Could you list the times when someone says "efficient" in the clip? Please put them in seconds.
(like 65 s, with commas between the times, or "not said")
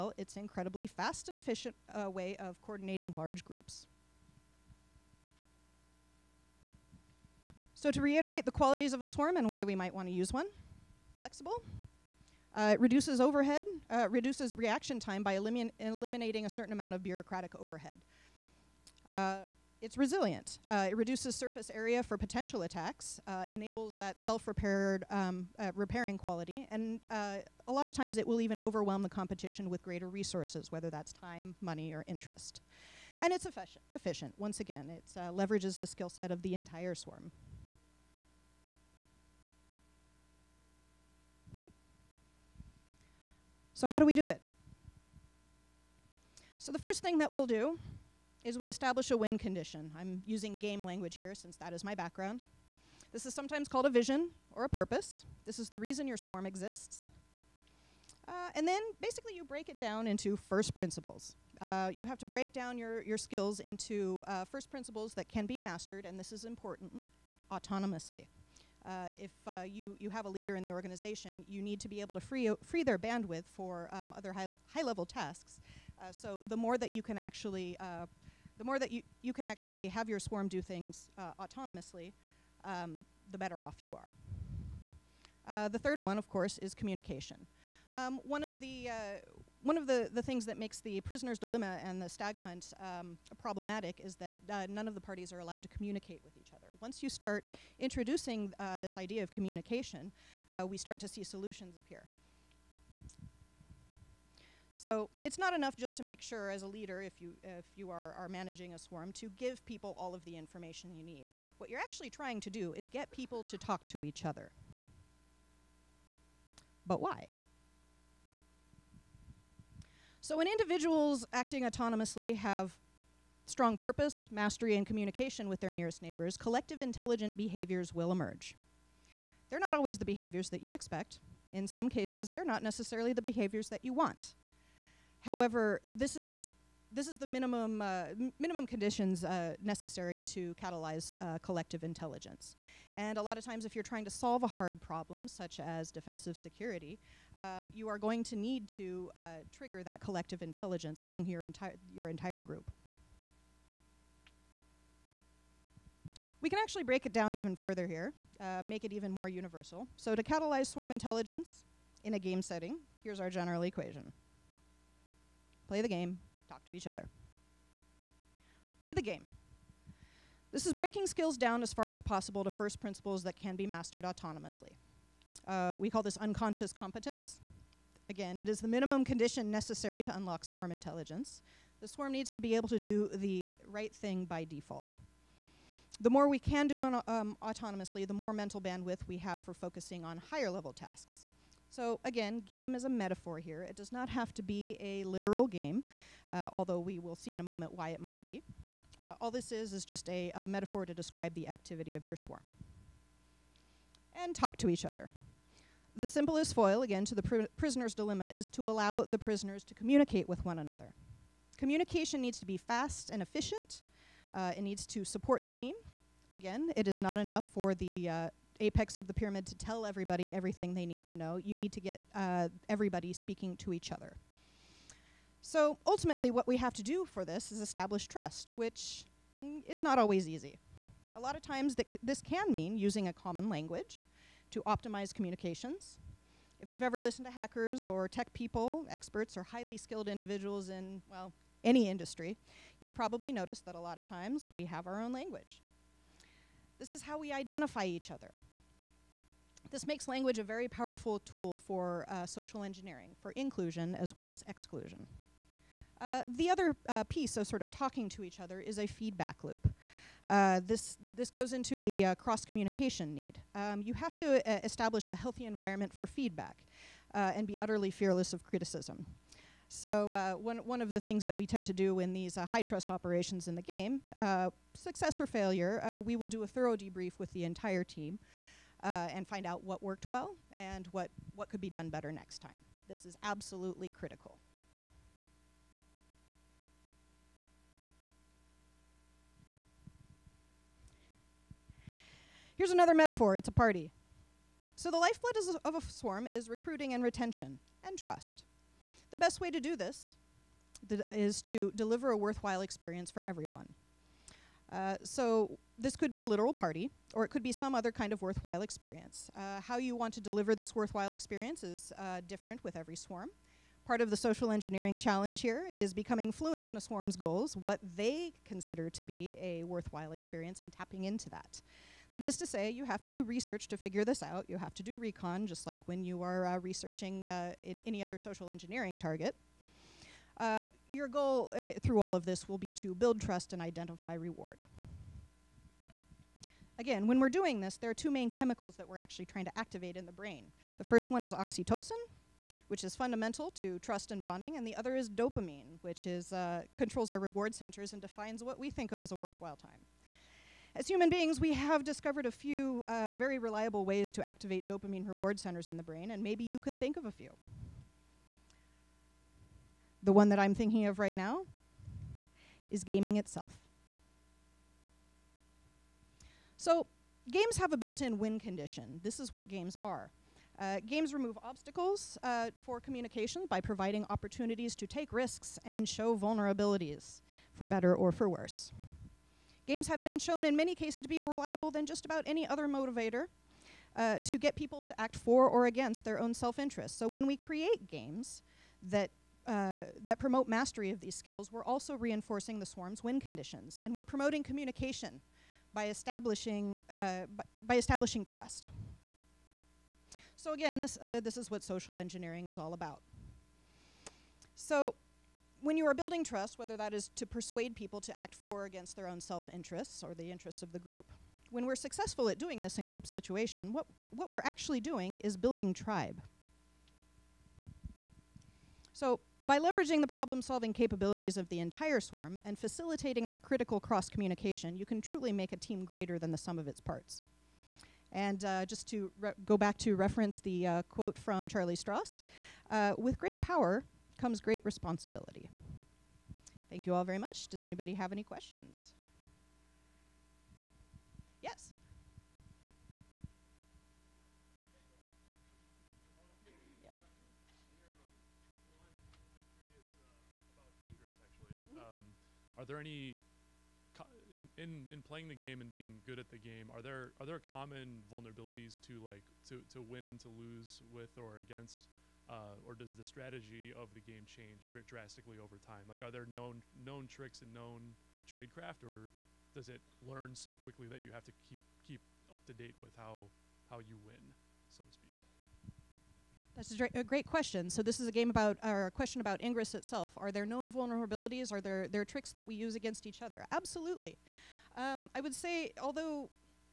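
1 s, 33 s, 213 s.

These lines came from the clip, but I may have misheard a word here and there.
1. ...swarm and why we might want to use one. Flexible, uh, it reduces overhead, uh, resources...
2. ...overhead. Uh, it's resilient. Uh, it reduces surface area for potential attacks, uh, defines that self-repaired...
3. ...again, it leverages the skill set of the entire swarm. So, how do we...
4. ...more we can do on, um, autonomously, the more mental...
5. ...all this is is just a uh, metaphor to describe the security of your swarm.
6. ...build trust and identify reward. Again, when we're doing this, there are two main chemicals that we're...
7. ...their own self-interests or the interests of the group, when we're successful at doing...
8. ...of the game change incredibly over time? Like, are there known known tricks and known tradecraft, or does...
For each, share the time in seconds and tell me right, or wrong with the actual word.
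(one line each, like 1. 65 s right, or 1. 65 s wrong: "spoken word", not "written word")
1. 9 s wrong: "reduces", not "resources"
2. 17 s wrong: "enables", not "defines"
3. 34 s right
4. 186 s right
5. 199 s wrong: "activity", not "security"
6. 332 s right
7. 408 s right
8. 463 s wrong: "drastically", not "incredibly".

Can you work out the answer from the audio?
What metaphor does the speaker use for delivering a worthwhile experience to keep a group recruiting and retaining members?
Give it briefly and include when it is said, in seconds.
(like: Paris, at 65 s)
A party, at 293 s.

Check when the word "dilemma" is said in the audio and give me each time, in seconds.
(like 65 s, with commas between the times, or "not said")
91 s, 207 s.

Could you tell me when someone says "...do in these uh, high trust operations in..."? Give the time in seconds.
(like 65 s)
271 s.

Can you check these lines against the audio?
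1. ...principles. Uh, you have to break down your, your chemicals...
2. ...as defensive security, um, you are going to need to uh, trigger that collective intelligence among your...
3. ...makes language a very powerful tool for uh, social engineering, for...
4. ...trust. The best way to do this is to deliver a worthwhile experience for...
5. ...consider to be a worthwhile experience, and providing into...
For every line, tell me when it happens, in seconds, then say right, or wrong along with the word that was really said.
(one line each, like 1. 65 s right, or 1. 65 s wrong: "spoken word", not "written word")
1. 60 s wrong: "skills", not "chemicals"
2. 145 s right
3. 249 s right
4. 297 s right
5. 318 s wrong: "tapping", not "providing".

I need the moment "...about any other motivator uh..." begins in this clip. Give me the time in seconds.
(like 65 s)
382 s.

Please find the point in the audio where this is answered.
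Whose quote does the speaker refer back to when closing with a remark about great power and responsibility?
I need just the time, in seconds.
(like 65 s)
431 s.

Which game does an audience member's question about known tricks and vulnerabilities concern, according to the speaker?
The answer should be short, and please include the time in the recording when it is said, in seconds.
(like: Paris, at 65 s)
Ingress, at 479 s.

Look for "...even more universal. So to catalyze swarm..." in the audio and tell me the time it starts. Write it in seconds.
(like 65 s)
158 s.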